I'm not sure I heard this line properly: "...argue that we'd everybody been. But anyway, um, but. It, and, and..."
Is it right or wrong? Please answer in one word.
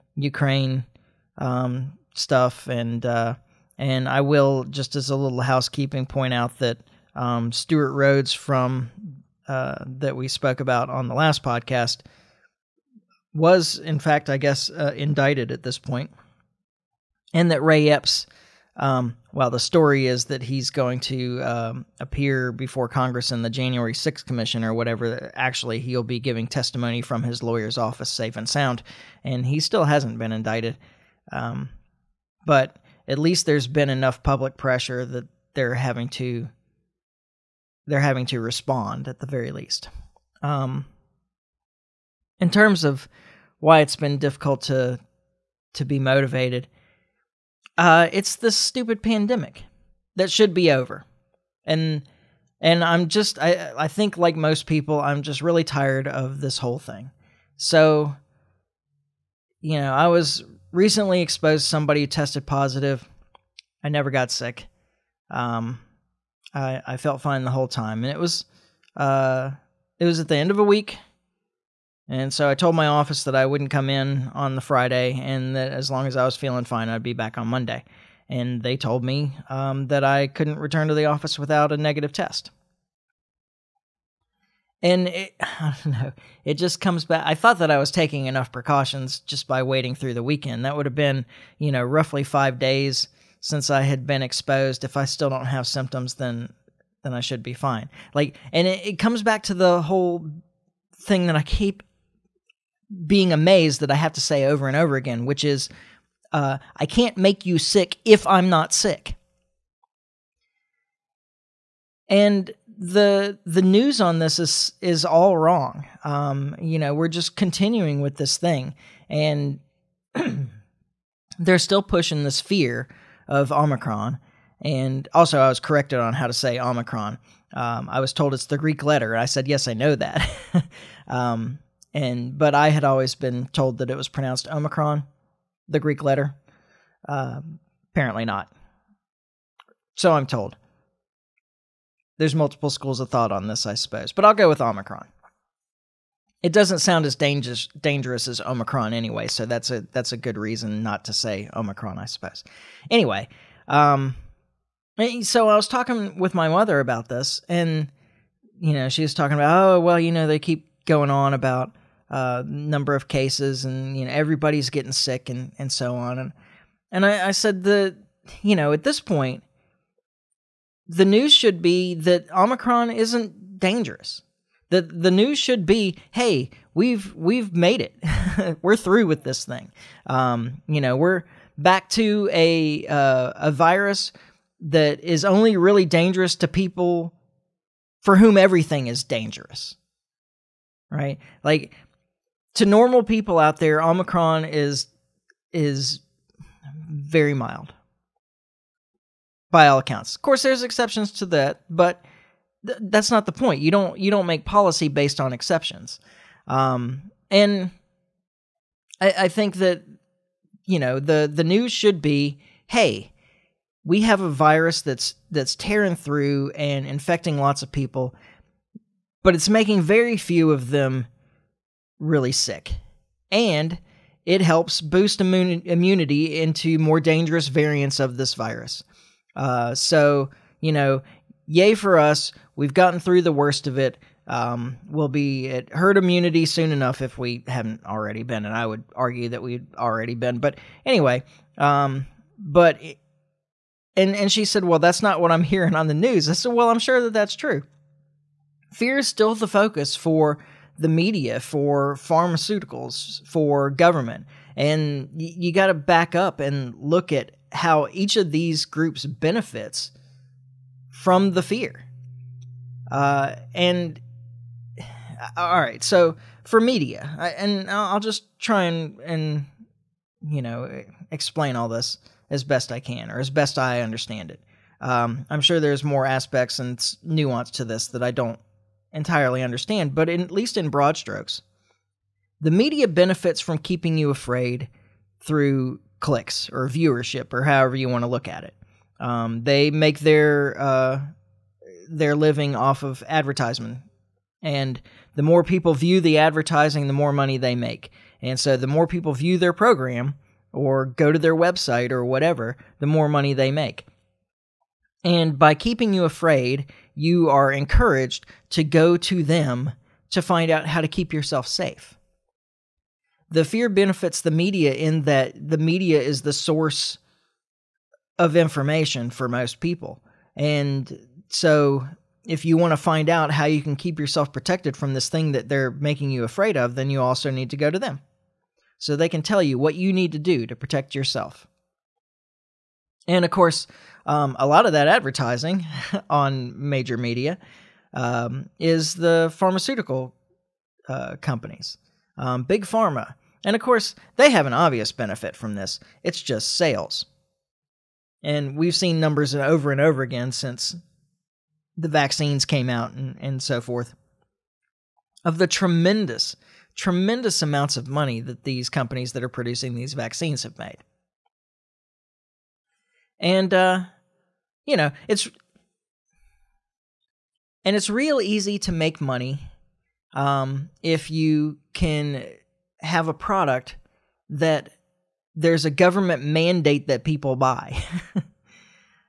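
wrong.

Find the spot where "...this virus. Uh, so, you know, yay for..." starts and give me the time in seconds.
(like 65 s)
228 s.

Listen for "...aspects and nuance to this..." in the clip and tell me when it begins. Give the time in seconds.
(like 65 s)
276 s.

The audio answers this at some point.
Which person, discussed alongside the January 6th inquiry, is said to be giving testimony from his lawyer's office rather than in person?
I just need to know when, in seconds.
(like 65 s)
17 s.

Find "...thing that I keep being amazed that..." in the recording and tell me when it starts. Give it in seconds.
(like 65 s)
101 s.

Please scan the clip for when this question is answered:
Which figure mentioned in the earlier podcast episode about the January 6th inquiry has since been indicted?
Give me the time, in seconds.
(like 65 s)
7 s.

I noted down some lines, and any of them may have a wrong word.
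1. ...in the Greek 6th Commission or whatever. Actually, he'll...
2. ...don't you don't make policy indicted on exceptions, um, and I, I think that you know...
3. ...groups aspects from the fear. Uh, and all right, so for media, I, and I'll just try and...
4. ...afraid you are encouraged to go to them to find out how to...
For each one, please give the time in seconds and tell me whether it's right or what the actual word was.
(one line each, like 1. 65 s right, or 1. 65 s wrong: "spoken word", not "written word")
1. 23 s wrong: "January", not "Greek"
2. 203 s wrong: "based", not "indicted"
3. 258 s wrong: "benefits", not "aspects"
4. 306 s right.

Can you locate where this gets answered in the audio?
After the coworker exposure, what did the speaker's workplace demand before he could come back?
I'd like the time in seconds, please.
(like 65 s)
81 s.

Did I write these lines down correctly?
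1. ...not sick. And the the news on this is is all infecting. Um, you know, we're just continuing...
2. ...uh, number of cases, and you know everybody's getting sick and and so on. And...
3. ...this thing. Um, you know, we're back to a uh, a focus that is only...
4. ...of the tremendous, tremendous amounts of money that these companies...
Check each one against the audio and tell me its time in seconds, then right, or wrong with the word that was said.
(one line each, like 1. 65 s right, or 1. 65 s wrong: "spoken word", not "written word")
1. 108 s wrong: "wrong", not "infecting"
2. 162 s right
3. 179 s wrong: "virus", not "focus"
4. 355 s right.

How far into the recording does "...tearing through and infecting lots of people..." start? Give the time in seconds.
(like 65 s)
215 s.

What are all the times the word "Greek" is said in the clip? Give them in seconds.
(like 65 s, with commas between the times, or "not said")
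128 s, 135 s.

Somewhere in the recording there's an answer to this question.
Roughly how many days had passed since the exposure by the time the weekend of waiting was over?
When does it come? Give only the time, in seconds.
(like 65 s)
92 s.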